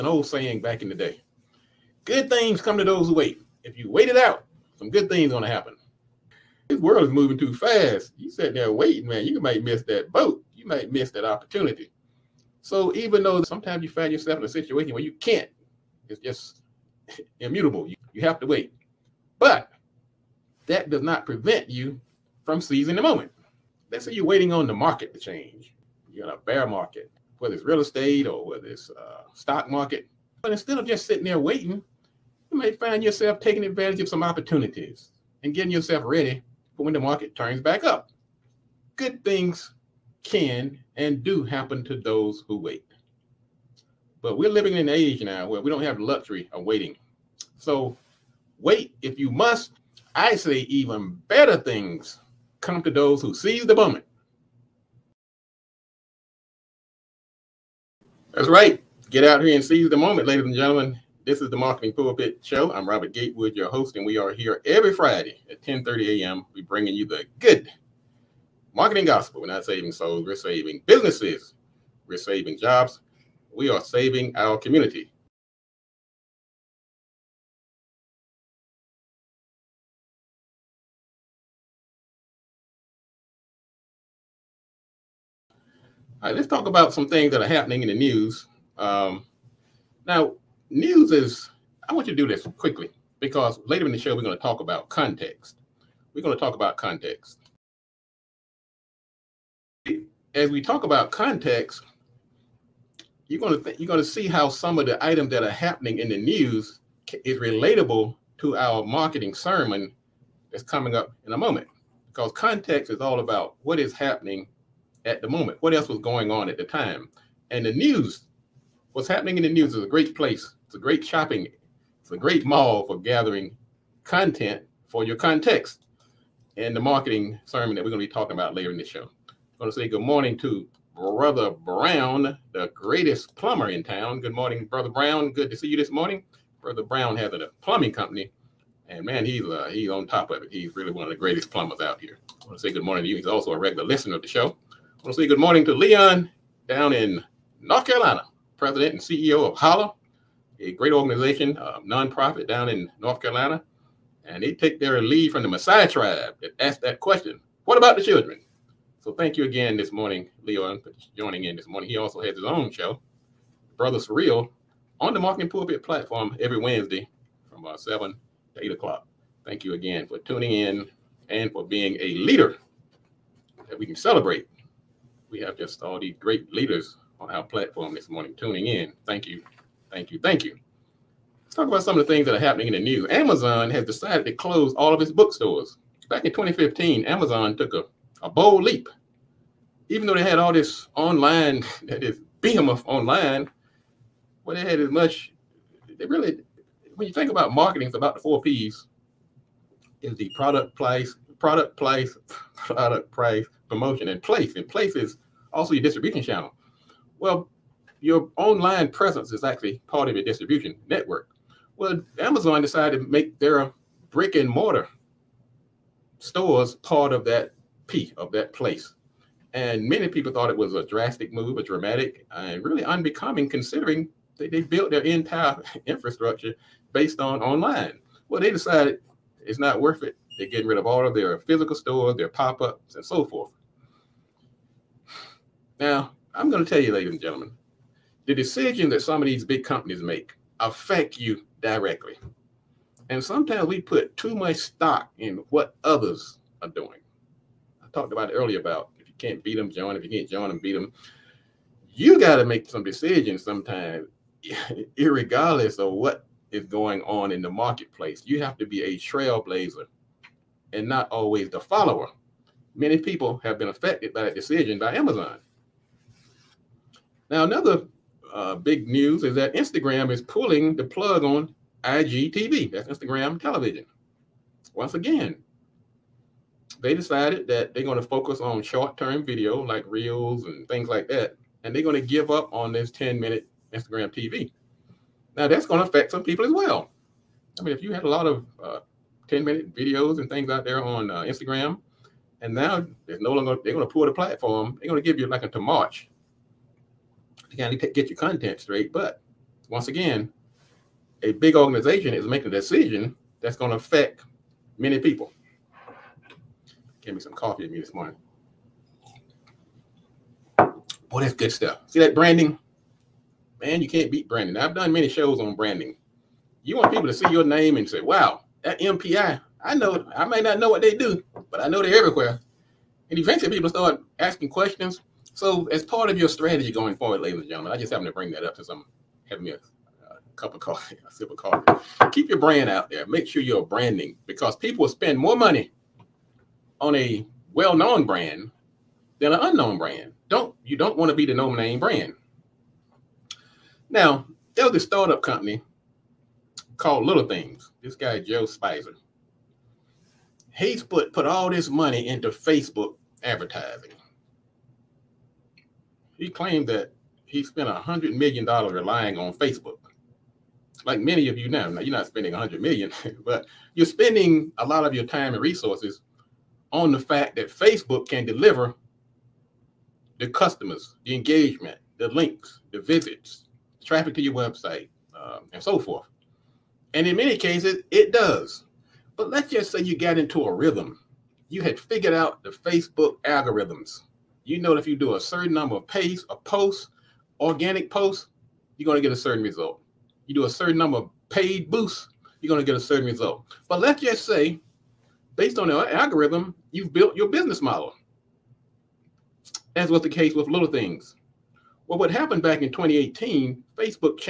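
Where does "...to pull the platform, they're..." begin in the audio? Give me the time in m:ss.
4:53.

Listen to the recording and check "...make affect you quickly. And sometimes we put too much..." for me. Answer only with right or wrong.
wrong.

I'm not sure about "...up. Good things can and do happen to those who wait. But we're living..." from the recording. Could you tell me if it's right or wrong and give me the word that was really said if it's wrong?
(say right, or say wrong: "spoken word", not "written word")
right.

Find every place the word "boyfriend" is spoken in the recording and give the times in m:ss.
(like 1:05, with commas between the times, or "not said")
not said.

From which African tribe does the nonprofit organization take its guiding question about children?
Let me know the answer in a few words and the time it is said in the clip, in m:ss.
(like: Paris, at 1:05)
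Masai, at 2:35.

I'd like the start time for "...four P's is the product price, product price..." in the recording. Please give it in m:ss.
3:18.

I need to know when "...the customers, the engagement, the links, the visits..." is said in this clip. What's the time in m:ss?
6:10.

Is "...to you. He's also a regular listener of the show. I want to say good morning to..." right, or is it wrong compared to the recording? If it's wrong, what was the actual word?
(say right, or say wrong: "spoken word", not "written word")
right.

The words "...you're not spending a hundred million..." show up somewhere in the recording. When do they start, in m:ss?
6:01.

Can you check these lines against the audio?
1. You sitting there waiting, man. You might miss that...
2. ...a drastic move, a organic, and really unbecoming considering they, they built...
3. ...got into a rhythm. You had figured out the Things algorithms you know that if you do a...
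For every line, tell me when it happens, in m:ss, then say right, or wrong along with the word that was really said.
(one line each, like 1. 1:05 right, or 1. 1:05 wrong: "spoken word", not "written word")
1. 0:08 right
2. 3:40 wrong: "dramatic", not "organic"
3. 6:19 wrong: "Facebook", not "Things".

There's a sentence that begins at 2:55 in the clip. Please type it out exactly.
We have just all these great leaders on our platform this morning, tuning in.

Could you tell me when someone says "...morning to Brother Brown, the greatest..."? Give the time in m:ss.
2:10.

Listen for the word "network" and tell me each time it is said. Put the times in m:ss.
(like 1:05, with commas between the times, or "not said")
3:30.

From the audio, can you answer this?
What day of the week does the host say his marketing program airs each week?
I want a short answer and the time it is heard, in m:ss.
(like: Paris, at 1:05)
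Friday, at 1:04.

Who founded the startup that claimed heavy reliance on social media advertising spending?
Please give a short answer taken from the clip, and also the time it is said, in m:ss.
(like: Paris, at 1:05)
Joe Speiser, at 5:48.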